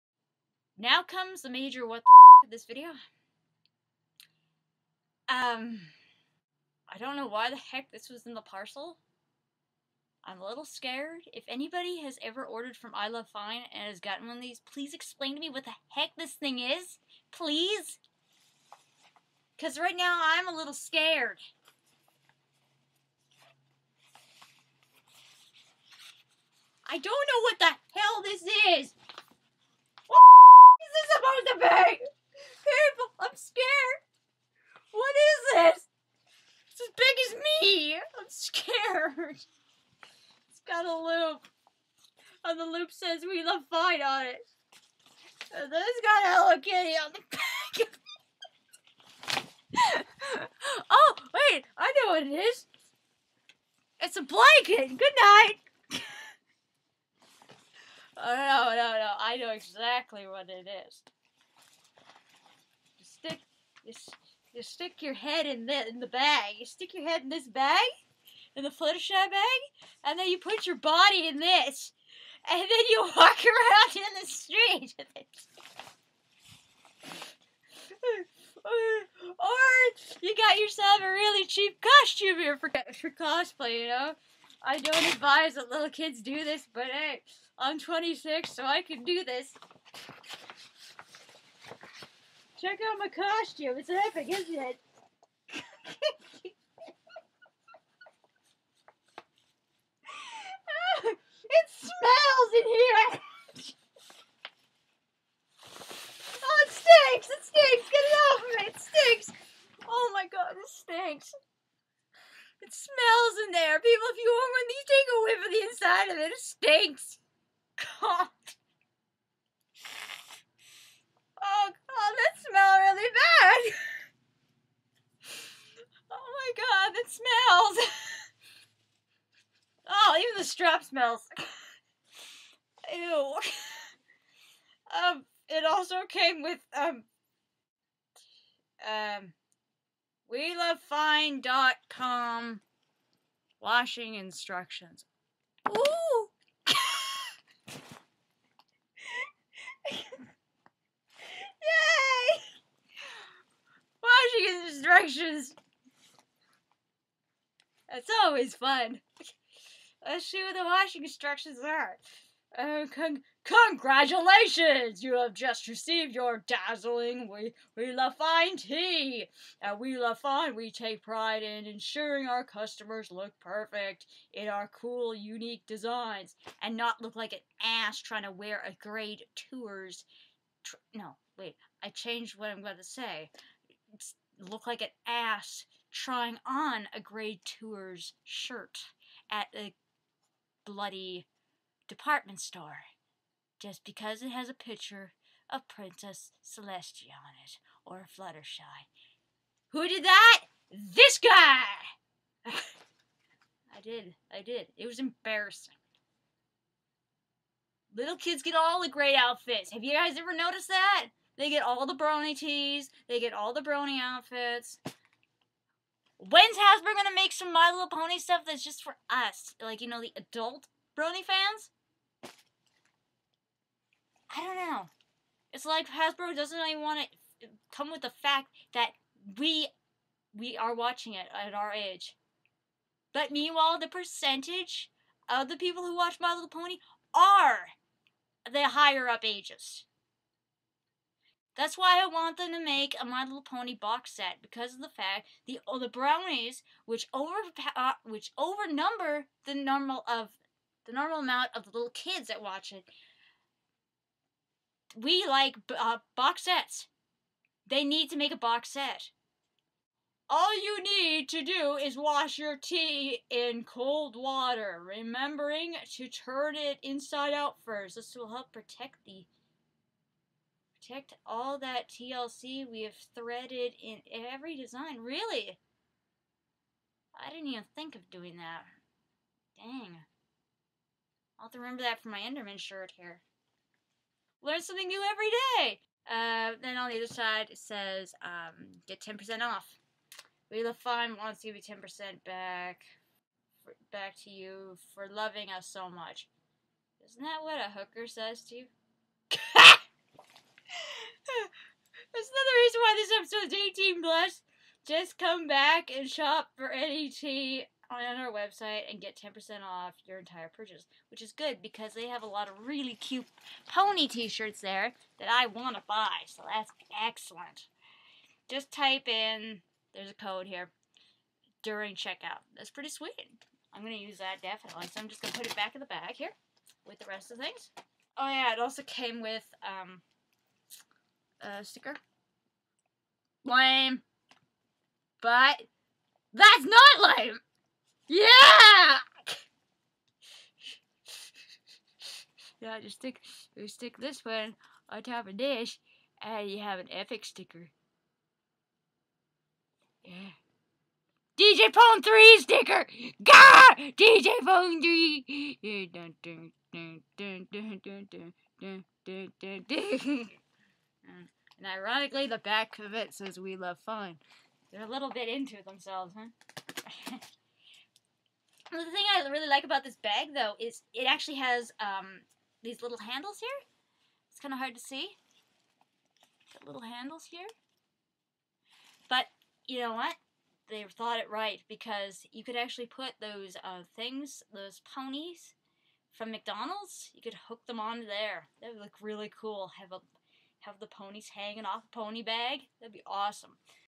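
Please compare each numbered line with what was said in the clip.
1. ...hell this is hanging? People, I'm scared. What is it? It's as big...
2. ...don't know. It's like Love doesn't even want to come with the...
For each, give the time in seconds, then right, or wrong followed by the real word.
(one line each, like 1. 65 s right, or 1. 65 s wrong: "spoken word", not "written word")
1. 27 s wrong: "happening", not "hanging"
2. 224 s wrong: "Hasbro", not "Love".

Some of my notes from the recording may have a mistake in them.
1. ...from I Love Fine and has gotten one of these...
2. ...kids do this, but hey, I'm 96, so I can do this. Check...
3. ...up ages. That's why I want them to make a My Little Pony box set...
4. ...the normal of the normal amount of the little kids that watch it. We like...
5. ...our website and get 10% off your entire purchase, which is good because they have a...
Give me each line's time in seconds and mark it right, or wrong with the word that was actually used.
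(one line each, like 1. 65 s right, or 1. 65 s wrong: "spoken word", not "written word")
1. 12 s right
2. 85 s wrong: "26", not "96"
3. 239 s right
4. 249 s right
5. 308 s right.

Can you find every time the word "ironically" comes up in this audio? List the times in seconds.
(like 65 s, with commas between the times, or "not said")
361 s.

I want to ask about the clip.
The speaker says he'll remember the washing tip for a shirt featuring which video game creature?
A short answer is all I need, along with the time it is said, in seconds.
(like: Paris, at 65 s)
Enderman, at 282 s.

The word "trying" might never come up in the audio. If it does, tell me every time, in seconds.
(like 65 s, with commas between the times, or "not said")
177 s, 185 s.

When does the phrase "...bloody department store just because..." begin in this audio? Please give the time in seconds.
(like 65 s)
190 s.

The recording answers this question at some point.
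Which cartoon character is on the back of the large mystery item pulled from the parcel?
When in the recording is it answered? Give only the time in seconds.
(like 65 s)
46 s.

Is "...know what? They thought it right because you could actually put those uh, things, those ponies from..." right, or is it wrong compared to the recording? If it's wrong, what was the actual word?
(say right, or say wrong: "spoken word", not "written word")
right.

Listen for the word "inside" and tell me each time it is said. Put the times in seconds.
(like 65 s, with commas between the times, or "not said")
115 s, 266 s.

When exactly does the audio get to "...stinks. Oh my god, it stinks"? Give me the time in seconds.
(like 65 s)
108 s.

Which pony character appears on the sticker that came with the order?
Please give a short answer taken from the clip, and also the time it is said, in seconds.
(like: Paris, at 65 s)
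DJ Pon-3, at 351 s.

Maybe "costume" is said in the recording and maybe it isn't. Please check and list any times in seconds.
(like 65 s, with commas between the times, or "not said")
82 s, 93 s.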